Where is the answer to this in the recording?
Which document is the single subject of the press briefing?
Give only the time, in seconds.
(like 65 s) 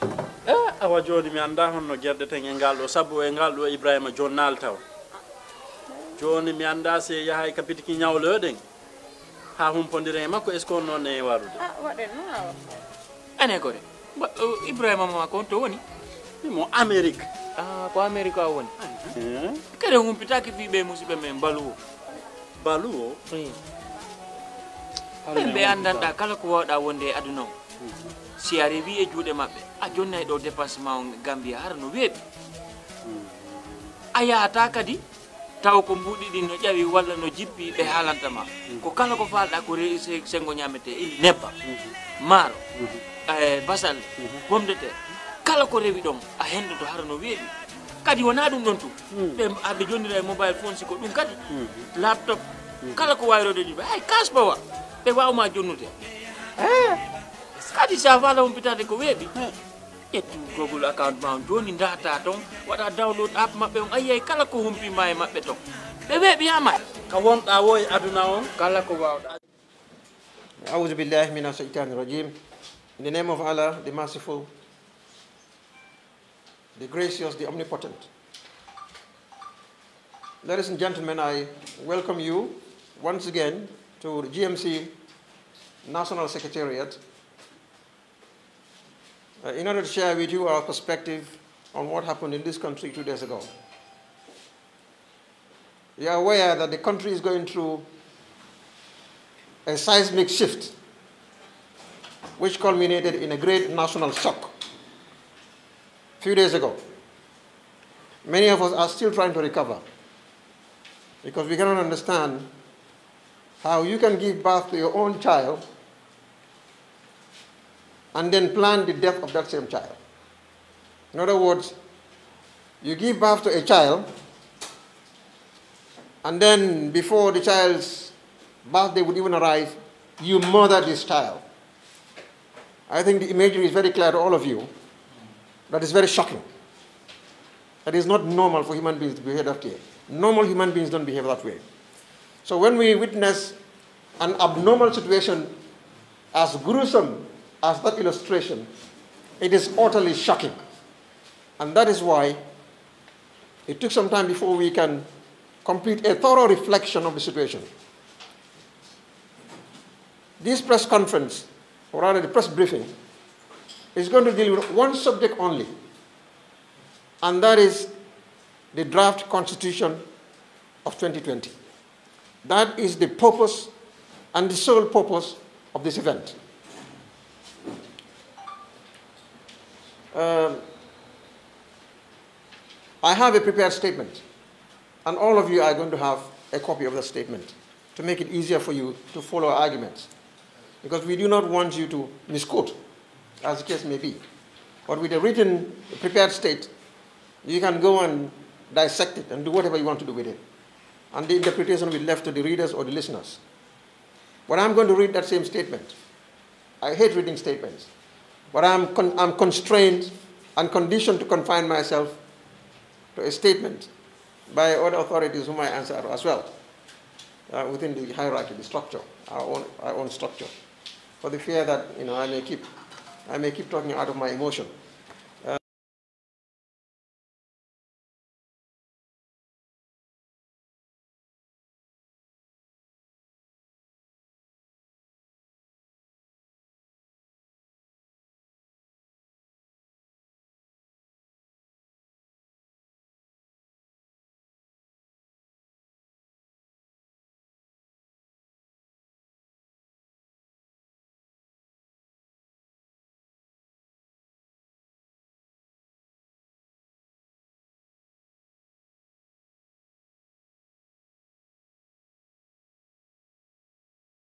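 168 s.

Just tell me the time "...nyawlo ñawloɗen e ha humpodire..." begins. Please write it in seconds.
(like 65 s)
7 s.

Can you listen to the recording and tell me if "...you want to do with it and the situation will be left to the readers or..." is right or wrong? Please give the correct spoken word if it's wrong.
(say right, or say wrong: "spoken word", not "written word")
wrong: "interpretation", not "situation".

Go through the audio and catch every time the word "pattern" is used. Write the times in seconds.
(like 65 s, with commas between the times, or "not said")
not said.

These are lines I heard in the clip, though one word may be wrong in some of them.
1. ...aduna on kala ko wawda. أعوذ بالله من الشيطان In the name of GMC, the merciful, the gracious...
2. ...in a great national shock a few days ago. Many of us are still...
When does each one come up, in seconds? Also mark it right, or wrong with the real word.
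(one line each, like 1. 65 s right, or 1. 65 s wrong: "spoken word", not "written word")
1. 67 s wrong: "Allah", not "GMC"
2. 103 s right.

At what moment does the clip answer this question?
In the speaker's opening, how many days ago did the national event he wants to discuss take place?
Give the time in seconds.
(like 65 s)
92 s.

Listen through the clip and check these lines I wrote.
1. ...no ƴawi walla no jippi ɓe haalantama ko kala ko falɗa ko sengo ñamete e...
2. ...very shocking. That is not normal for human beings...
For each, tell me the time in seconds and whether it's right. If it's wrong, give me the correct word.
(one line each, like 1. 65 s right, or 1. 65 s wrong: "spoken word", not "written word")
1. 36 s right
2. 135 s right.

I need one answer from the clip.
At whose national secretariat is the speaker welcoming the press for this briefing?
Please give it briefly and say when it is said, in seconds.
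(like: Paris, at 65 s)
GMC, at 84 s.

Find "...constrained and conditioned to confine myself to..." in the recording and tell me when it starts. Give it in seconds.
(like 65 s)
209 s.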